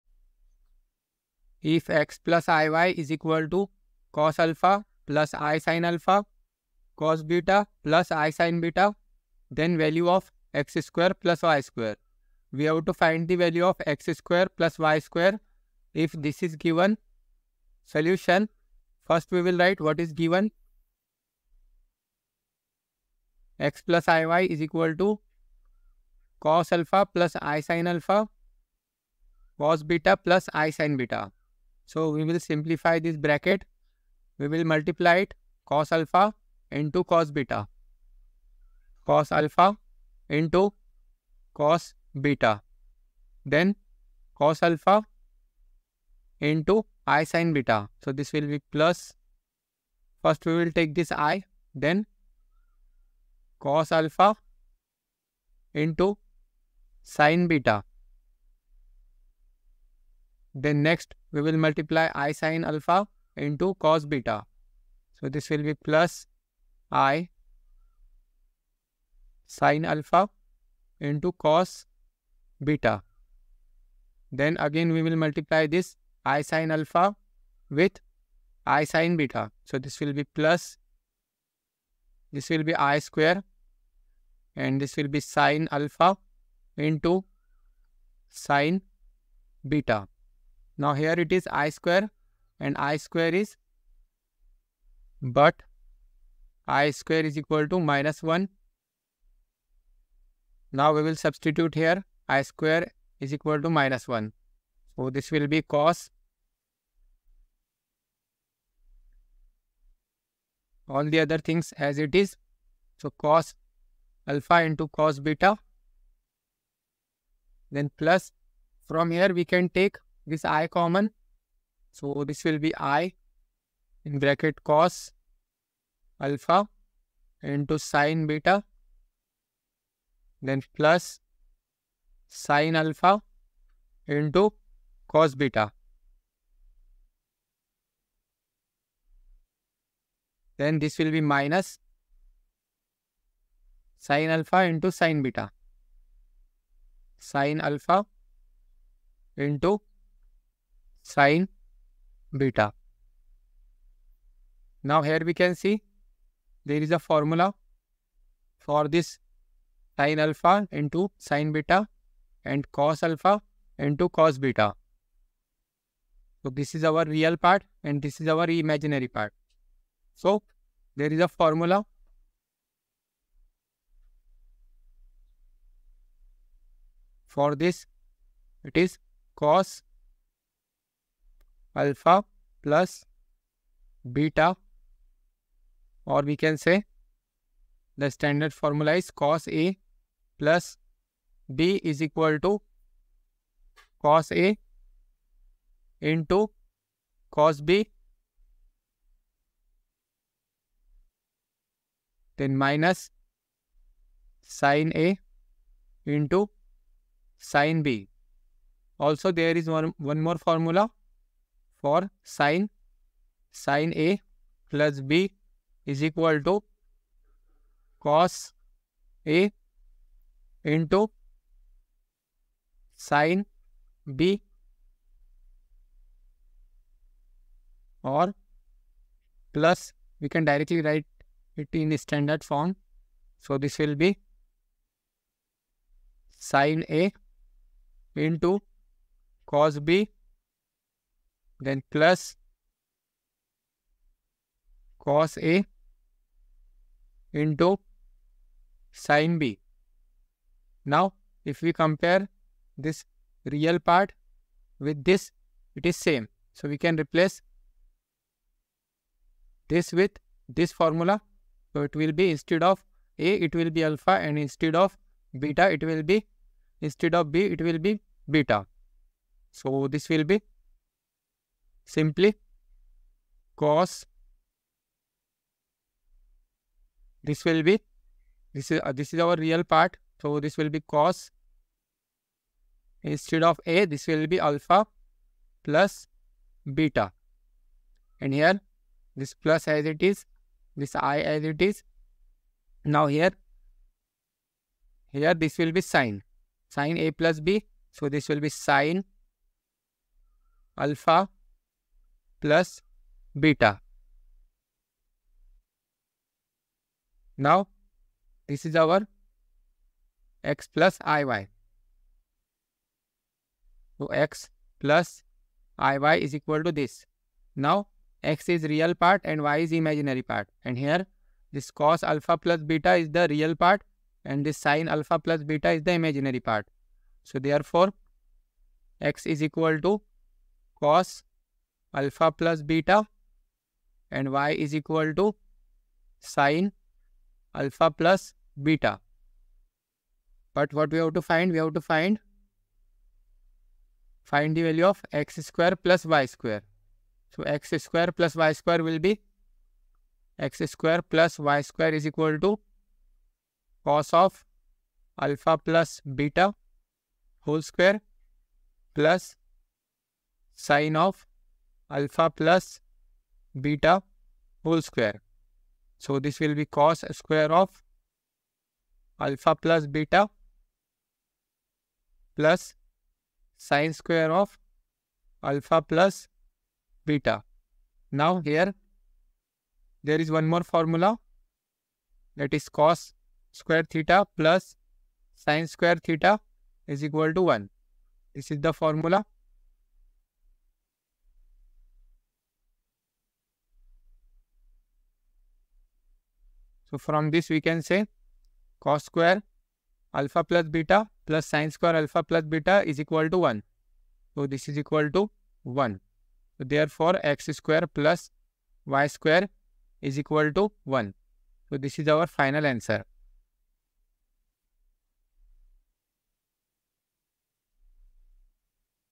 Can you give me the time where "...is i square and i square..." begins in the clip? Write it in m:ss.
1:31.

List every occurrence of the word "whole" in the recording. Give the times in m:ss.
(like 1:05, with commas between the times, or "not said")
5:57, 6:04.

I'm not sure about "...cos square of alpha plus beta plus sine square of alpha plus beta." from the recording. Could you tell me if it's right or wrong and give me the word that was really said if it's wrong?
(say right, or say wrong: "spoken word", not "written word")
right.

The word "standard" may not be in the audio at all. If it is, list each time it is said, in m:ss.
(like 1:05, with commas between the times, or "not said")
3:08, 3:51.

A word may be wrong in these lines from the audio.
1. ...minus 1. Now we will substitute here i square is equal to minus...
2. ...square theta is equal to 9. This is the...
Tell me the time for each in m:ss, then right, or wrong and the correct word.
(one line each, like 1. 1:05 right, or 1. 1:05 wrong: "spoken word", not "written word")
1. 1:37 right
2. 6:25 wrong: "1", not "9".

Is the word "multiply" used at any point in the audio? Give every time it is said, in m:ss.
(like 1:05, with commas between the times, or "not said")
0:34, 1:01, 1:15.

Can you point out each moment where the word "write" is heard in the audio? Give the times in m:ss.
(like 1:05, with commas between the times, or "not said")
0:19, 3:50.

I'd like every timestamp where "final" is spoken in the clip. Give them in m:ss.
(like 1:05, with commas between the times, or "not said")
6:52.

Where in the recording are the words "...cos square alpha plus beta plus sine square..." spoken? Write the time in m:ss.
6:38.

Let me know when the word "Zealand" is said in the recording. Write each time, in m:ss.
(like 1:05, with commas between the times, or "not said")
not said.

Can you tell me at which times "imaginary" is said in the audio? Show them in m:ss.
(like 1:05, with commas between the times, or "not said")
2:48, 5:19, 5:25.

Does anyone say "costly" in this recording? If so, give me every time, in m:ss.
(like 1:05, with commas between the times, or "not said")
not said.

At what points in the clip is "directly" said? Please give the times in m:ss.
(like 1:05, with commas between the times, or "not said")
3:50.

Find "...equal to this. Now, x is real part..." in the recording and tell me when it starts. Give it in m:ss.
5:16.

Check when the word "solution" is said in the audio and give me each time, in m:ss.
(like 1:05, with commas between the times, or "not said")
0:17.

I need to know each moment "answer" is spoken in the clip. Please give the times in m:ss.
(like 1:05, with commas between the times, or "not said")
6:52.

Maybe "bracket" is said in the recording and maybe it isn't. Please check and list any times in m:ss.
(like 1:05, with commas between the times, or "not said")
0:33, 2:04.